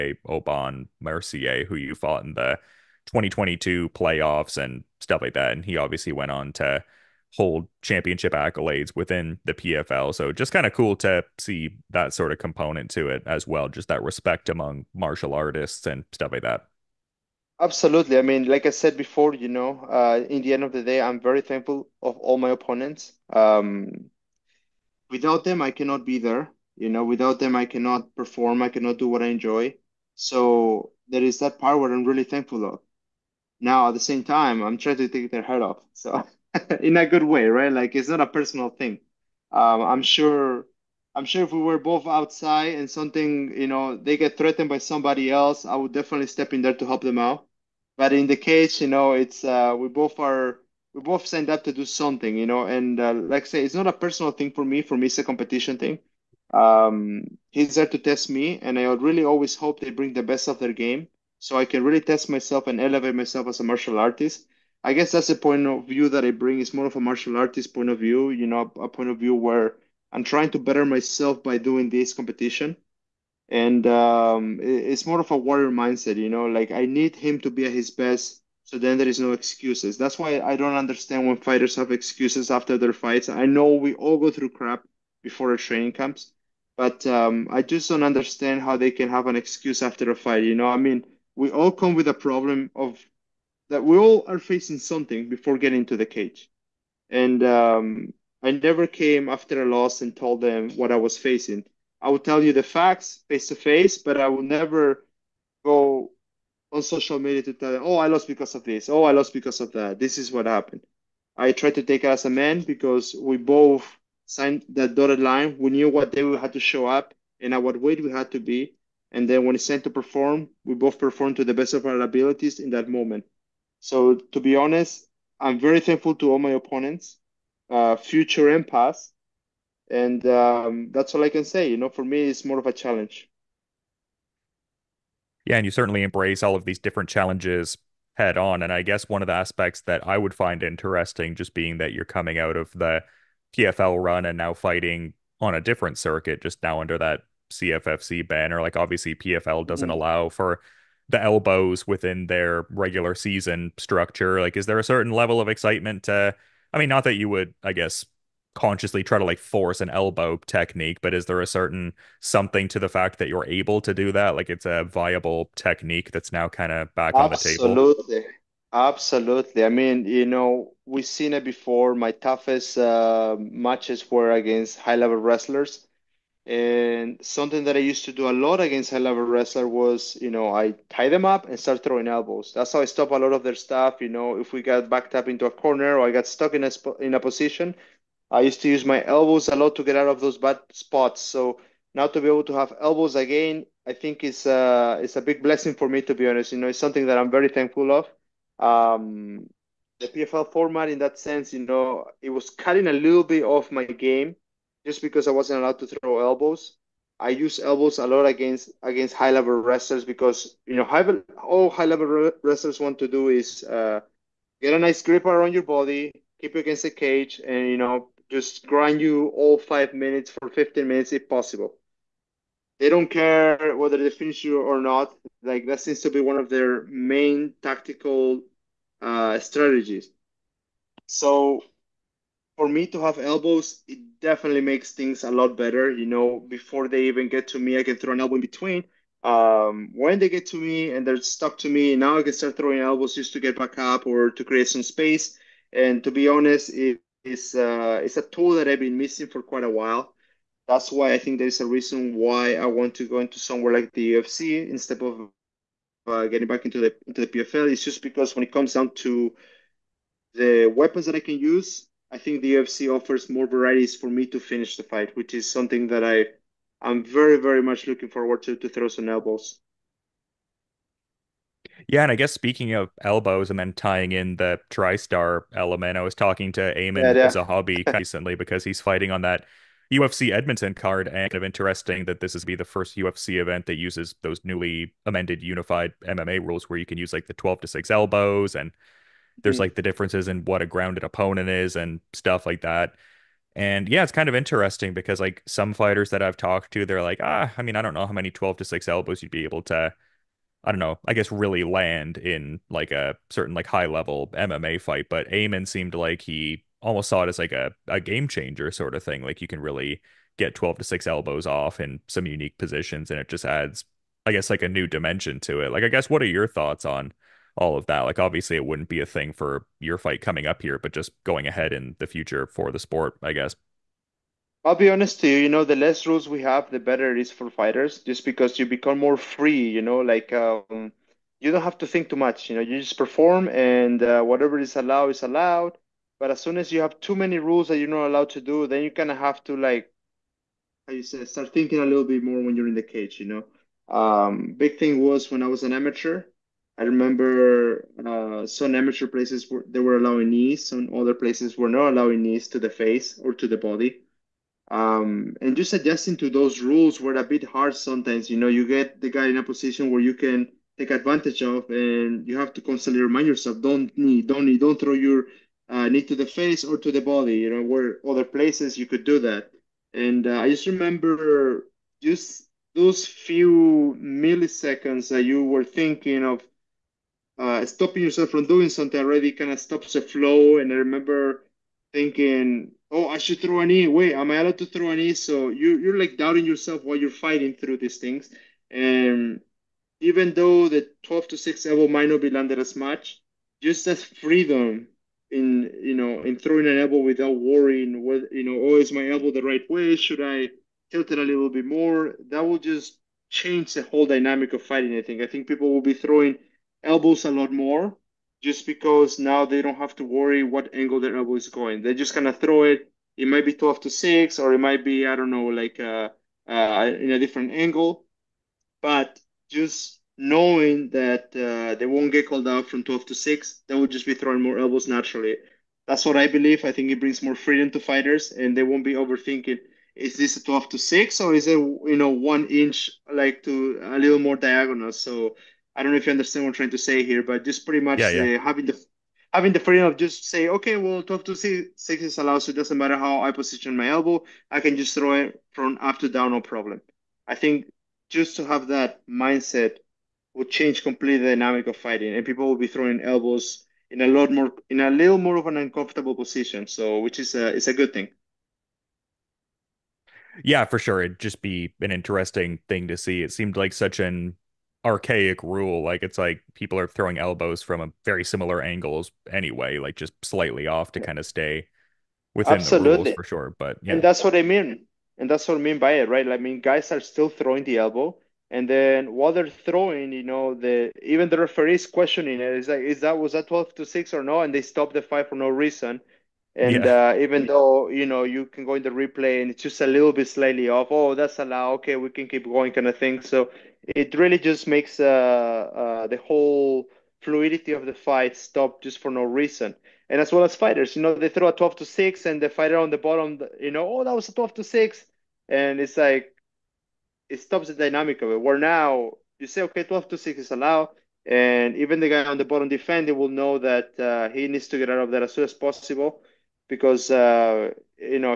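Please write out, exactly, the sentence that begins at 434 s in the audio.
So I don't know if you understand what I'm trying to say here, but just pretty much yeah, yeah.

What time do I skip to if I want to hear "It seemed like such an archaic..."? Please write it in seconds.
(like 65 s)
463 s.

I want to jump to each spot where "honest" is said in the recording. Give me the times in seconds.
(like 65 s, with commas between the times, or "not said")
124 s, 196 s, 246 s, 324 s.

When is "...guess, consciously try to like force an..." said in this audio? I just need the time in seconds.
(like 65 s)
157 s.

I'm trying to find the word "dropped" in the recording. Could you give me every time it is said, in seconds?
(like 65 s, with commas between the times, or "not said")
not said.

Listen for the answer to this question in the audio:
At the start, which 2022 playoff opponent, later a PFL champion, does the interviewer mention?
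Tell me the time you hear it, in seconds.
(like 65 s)
0 s.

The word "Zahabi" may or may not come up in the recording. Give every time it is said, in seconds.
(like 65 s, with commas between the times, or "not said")
277 s.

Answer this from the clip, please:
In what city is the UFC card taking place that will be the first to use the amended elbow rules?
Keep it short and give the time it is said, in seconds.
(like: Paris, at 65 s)
Edmonton, at 280 s.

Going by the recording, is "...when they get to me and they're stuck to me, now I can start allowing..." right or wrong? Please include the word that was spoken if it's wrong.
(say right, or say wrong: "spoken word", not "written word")
wrong: "throwing", not "allowing".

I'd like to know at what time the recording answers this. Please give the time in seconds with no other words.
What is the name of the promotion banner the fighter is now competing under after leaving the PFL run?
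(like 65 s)
147 s.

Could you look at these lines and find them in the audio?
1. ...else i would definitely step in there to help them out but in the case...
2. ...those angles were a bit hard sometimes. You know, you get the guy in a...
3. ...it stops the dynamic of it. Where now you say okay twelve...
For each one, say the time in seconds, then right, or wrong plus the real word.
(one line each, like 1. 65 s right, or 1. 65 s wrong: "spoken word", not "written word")
1. 45 s right
2. 356 s wrong: "rules", not "angles"
3. 507 s right.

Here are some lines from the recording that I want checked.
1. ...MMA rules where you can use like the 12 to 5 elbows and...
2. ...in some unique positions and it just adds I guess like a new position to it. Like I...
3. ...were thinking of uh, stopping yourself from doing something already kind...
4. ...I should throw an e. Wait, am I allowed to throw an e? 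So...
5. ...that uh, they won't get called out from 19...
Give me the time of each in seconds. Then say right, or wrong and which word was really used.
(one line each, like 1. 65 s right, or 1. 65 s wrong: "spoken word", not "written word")
1. 286 s wrong: "6", not "5"
2. 311 s wrong: "dimension", not "position"
3. 375 s right
4. 383 s right
5. 420 s wrong: "12", not "19".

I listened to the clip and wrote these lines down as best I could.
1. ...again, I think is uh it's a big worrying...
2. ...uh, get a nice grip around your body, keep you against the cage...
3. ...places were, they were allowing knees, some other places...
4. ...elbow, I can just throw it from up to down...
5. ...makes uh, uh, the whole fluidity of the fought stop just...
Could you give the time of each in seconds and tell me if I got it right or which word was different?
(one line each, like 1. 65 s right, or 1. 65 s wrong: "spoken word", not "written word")
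1. 193 s wrong: "blessing", not "worrying"
2. 213 s right
3. 349 s right
4. 443 s right
5. 494 s wrong: "fight", not "fought".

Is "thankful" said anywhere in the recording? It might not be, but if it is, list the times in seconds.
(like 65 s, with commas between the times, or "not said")
21 s, 32 s, 125 s, 197 s.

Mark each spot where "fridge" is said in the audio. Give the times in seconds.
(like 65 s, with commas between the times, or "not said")
not said.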